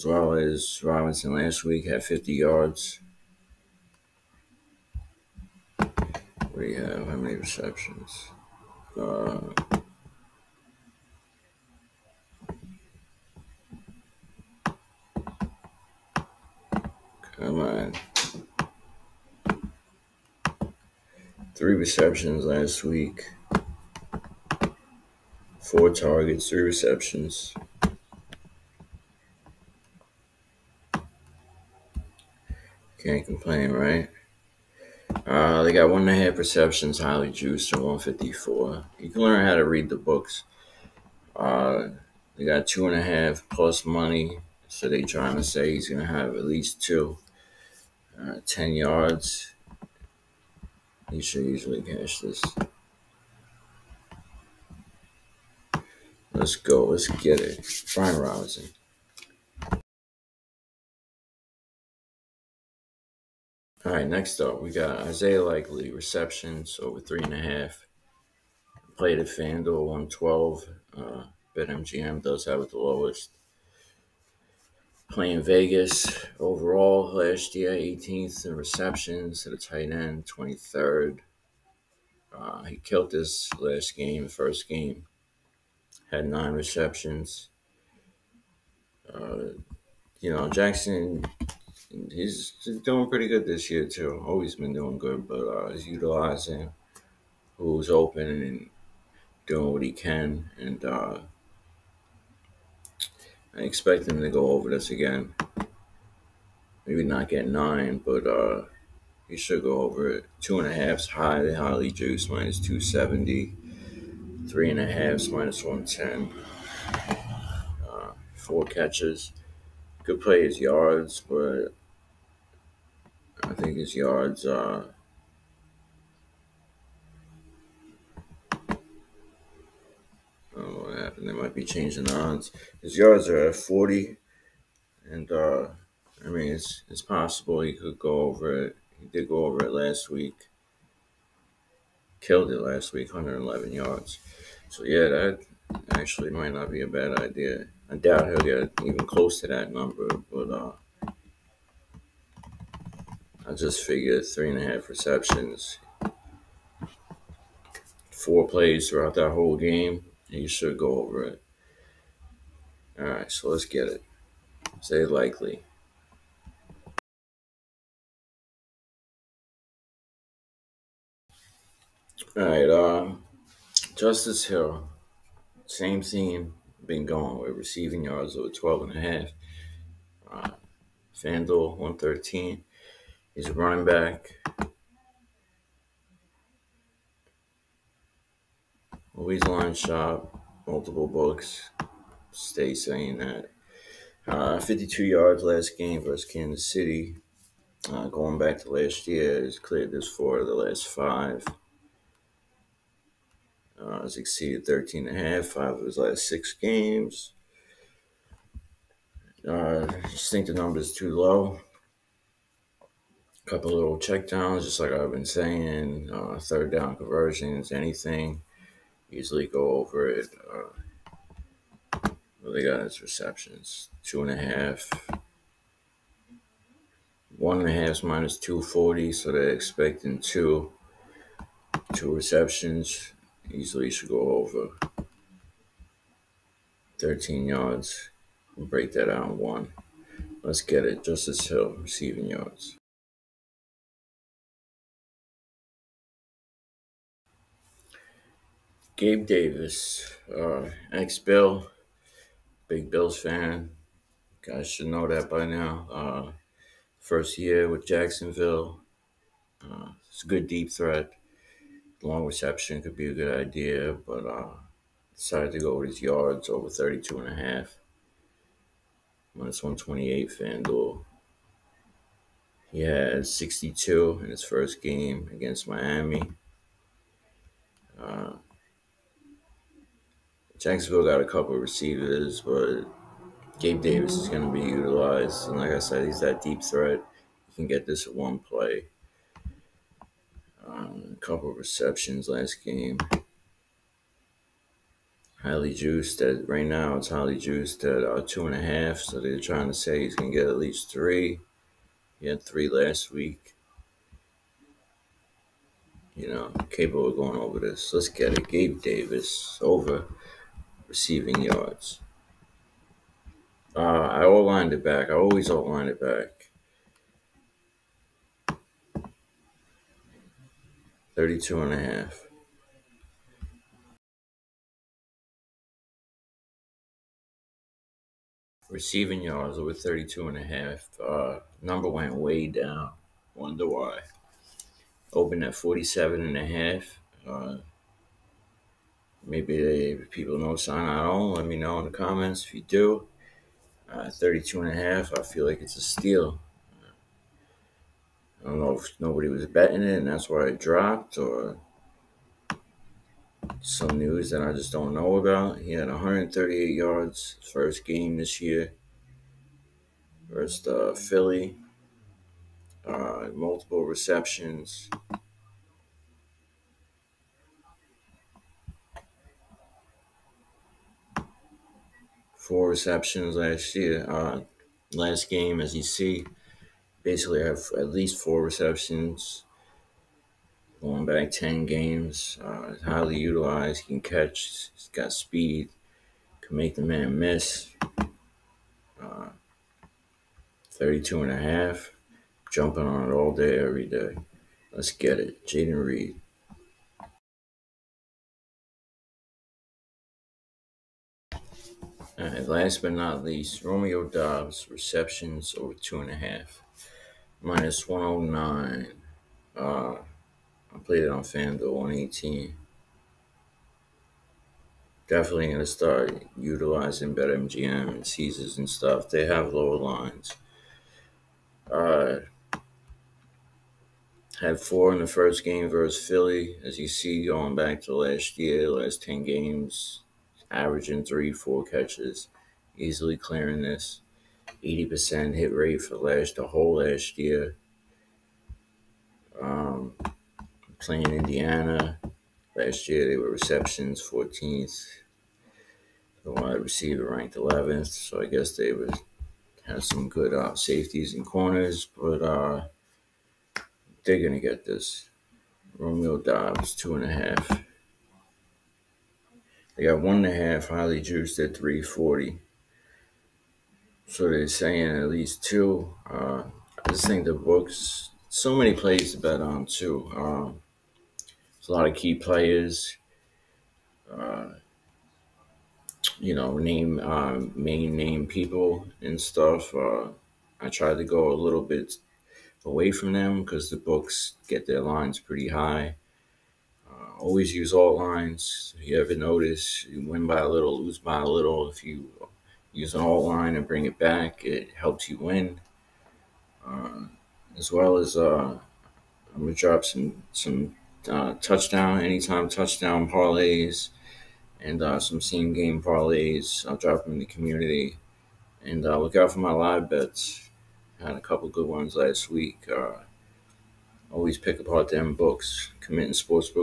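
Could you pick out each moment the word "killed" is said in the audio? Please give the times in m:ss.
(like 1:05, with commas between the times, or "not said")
1:22, 2:22.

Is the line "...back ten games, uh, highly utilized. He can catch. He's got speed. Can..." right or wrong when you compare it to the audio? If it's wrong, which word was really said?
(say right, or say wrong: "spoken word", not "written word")
right.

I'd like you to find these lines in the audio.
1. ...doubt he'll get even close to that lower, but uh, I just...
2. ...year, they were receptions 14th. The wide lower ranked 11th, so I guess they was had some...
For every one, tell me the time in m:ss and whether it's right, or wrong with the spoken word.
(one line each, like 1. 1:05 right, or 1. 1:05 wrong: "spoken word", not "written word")
1. 2:27 wrong: "number", not "lower"
2. 7:22 wrong: "receiver", not "lower".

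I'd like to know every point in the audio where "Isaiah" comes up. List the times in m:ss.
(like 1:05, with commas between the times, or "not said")
1:05, 2:44.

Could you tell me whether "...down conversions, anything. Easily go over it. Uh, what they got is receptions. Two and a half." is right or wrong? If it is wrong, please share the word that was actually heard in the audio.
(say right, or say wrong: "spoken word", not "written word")
right.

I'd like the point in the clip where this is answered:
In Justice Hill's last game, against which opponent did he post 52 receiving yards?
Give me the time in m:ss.
3:16.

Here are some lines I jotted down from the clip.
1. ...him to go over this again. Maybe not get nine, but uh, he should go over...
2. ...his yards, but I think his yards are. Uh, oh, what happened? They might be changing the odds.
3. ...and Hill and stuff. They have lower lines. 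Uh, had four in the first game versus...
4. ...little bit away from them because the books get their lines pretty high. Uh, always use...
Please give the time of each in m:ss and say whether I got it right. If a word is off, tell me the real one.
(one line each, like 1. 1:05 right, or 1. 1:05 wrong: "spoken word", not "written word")
1. 1:44 right
2. 2:00 right
3. 6:57 wrong: "Caesars", not "Hill"
4. 8:01 right.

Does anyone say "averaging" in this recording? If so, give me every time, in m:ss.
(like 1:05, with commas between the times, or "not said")
7:10.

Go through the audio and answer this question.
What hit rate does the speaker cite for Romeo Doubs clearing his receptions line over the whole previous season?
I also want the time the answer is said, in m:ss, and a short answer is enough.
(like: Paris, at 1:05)
80%, at 7:14.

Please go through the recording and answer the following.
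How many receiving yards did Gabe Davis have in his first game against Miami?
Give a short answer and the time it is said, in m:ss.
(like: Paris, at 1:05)
62, at 4:33.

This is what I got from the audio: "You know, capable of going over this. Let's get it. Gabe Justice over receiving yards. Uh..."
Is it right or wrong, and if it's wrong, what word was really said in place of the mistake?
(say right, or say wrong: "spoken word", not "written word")
wrong: "Davis", not "Justice".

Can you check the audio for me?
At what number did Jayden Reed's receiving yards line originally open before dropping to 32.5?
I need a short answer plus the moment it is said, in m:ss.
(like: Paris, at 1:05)
47.5, at 5:35.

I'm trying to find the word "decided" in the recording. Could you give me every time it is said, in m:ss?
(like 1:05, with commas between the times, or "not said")
4:25.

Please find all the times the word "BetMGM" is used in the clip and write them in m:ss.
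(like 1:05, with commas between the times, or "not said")
1:11, 6:57.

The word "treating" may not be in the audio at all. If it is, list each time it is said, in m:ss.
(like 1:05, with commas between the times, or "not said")
not said.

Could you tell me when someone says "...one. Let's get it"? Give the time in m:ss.
3:59.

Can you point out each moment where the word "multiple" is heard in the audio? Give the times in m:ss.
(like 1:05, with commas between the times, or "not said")
3:10, 6:03.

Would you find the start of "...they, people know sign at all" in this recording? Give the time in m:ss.
5:39.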